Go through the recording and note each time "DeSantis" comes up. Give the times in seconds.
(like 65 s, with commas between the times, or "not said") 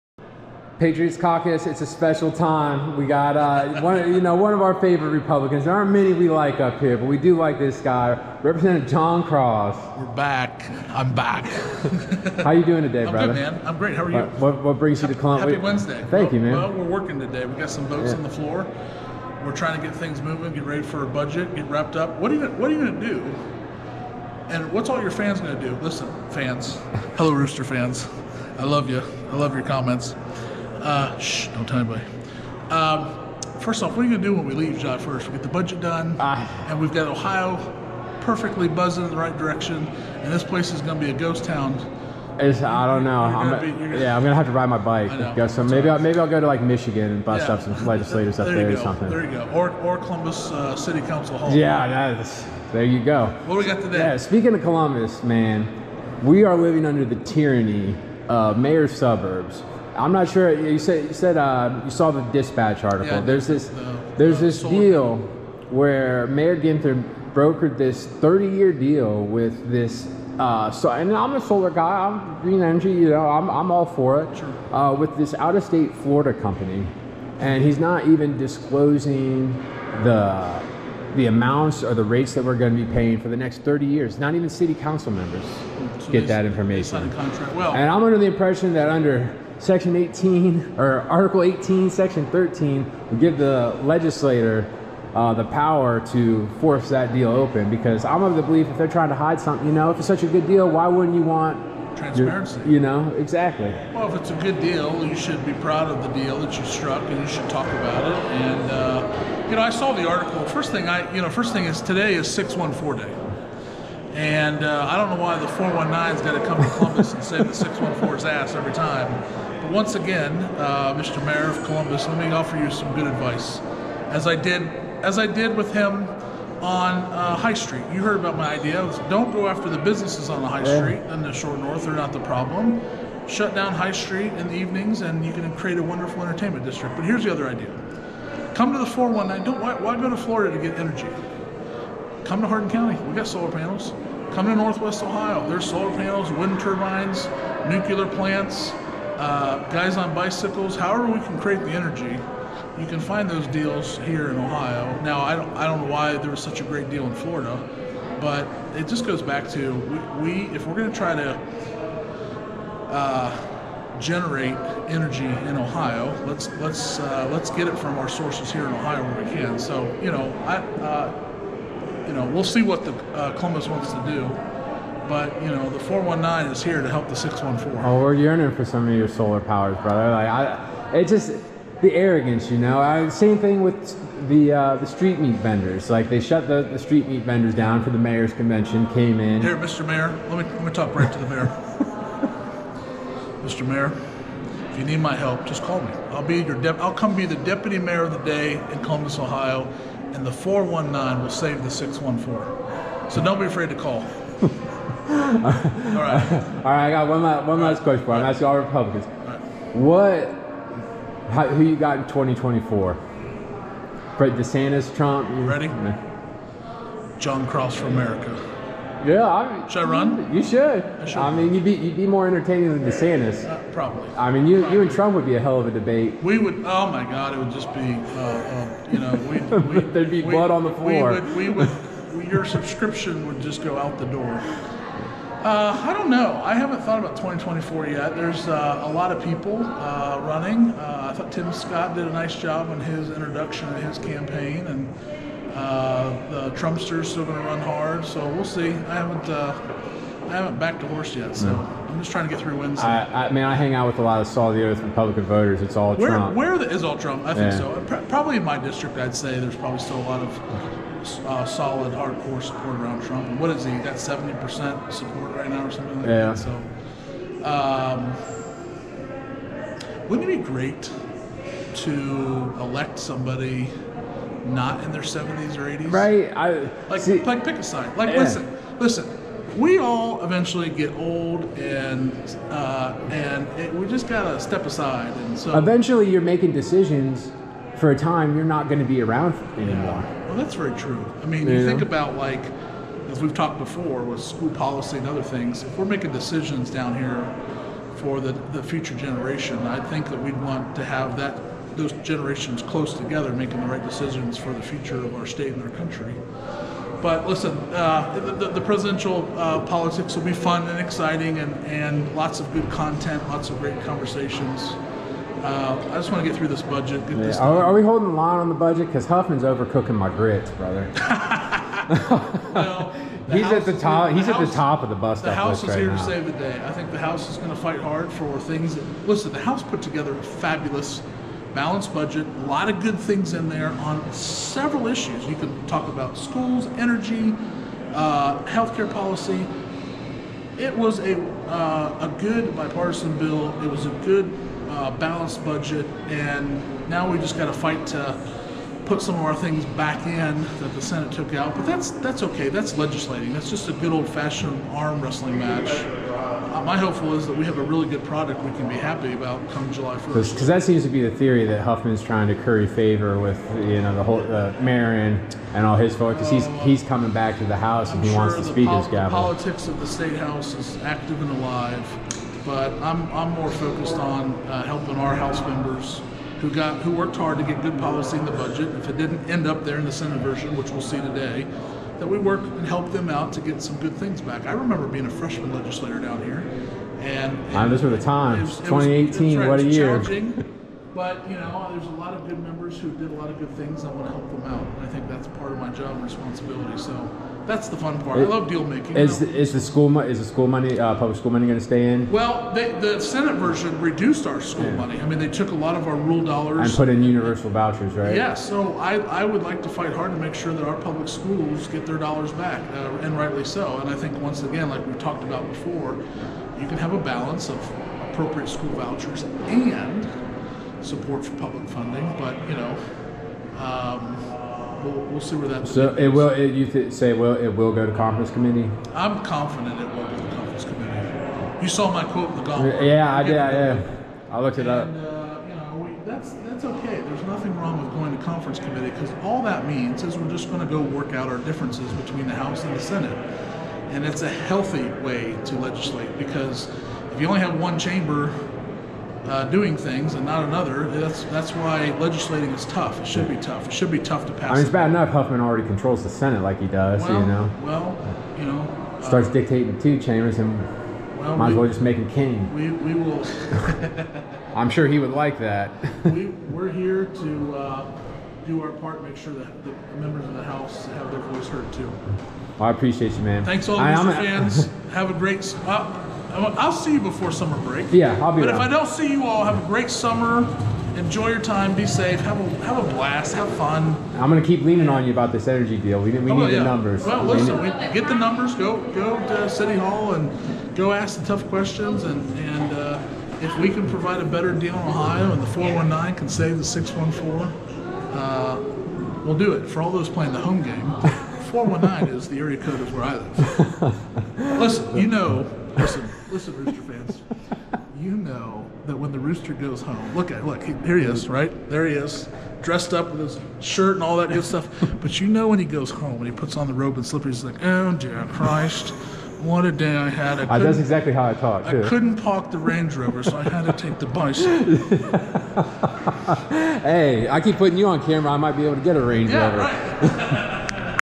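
214 s, 222 s.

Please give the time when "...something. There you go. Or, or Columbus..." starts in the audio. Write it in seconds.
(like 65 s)
48 s.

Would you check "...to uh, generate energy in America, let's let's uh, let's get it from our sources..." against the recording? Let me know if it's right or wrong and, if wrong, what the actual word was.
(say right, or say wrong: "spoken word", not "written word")
wrong: "Ohio", not "America".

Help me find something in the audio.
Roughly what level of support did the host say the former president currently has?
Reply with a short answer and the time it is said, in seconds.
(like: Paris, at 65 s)
70%, at 263 s.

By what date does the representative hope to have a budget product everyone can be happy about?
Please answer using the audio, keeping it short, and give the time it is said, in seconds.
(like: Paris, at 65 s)
July 1st, at 359 s.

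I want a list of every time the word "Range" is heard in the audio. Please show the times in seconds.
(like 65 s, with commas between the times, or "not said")
522 s, 529 s.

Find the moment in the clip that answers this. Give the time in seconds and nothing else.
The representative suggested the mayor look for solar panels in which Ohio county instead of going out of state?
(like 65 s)
142 s.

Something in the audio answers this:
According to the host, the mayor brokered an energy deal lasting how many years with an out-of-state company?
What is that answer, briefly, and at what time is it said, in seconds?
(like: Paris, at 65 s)
30, at 68 s.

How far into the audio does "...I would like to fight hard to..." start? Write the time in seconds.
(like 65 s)
408 s.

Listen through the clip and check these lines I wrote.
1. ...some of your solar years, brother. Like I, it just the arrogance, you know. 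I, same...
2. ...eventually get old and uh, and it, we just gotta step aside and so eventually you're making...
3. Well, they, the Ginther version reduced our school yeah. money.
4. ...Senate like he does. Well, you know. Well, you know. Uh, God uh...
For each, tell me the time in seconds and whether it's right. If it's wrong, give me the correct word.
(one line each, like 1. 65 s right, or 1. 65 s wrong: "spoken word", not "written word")
1. 178 s wrong: "powers", not "years"
2. 280 s right
3. 402 s wrong: "Senate", not "Ginther"
4. 456 s wrong: "Starts", not "God".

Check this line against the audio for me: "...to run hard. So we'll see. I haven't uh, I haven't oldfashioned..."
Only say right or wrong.
wrong.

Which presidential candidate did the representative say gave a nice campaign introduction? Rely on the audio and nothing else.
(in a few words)
Tim Scott.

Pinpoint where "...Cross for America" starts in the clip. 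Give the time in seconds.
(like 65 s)
217 s.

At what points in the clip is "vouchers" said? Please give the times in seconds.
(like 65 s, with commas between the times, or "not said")
407 s, 418 s.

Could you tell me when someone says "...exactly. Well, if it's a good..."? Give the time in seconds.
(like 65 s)
103 s.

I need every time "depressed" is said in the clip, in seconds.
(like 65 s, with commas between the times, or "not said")
not said.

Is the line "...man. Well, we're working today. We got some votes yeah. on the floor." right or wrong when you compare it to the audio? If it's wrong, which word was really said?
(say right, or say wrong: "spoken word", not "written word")
right.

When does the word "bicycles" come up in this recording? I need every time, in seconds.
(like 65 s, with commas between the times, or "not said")
150 s, 524 s.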